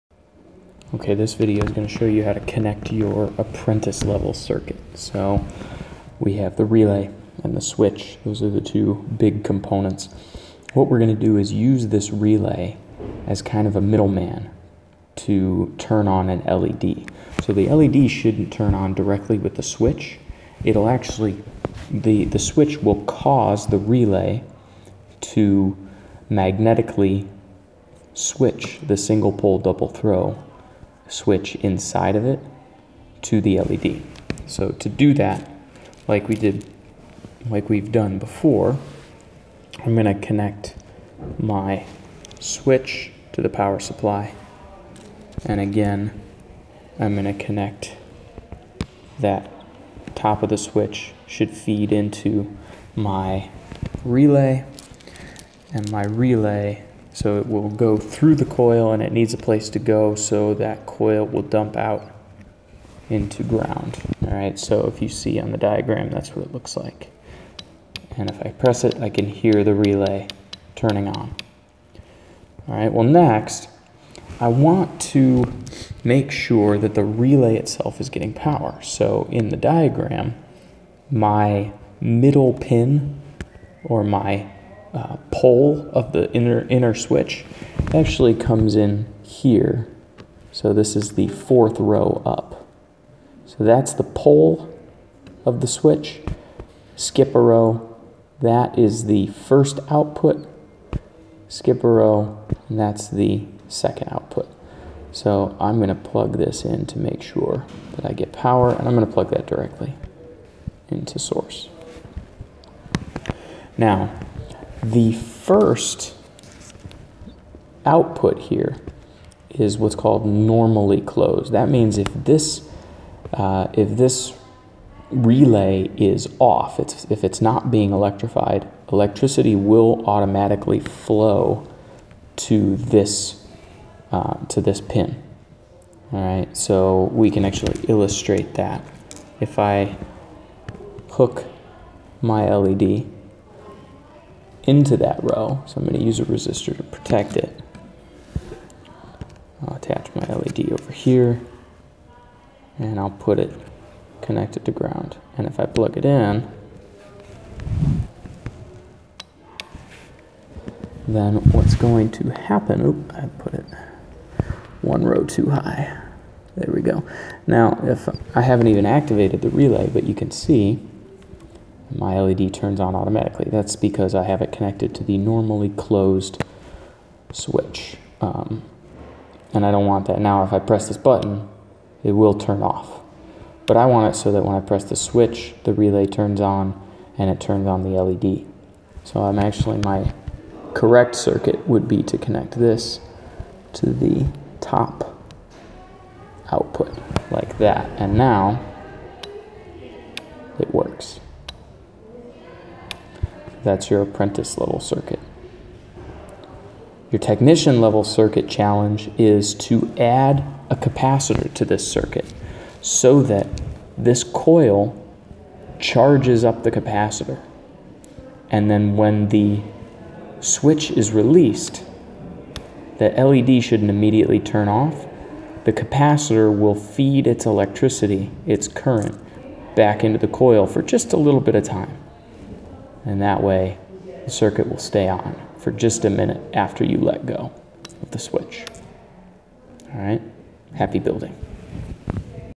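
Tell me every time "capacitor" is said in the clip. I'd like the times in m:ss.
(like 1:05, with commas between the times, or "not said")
3:30, 3:36, 3:45.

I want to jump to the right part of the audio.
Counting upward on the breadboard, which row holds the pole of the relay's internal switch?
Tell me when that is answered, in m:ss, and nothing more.
1:31.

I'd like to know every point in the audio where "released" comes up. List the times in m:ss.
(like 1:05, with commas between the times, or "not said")
3:41.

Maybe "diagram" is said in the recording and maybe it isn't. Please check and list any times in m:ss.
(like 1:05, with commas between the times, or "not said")
1:05, 1:19.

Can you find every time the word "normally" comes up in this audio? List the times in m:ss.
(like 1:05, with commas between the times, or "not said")
2:00, 2:55.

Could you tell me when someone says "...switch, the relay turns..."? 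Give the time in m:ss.
3:04.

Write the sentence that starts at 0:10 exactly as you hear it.
What we're going to do is use this relay as kind of a middleman to turn on an LED.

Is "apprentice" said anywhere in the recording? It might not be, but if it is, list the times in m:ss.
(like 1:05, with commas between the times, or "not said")
0:03, 3:24.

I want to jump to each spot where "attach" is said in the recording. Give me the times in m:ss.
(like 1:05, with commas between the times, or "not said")
2:29.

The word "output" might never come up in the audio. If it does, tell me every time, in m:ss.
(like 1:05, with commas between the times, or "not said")
1:39, 1:44, 1:57, 3:16.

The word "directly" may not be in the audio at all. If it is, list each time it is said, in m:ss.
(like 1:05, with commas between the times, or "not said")
0:18, 1:49.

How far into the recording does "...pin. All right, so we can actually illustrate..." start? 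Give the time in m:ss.
2:14.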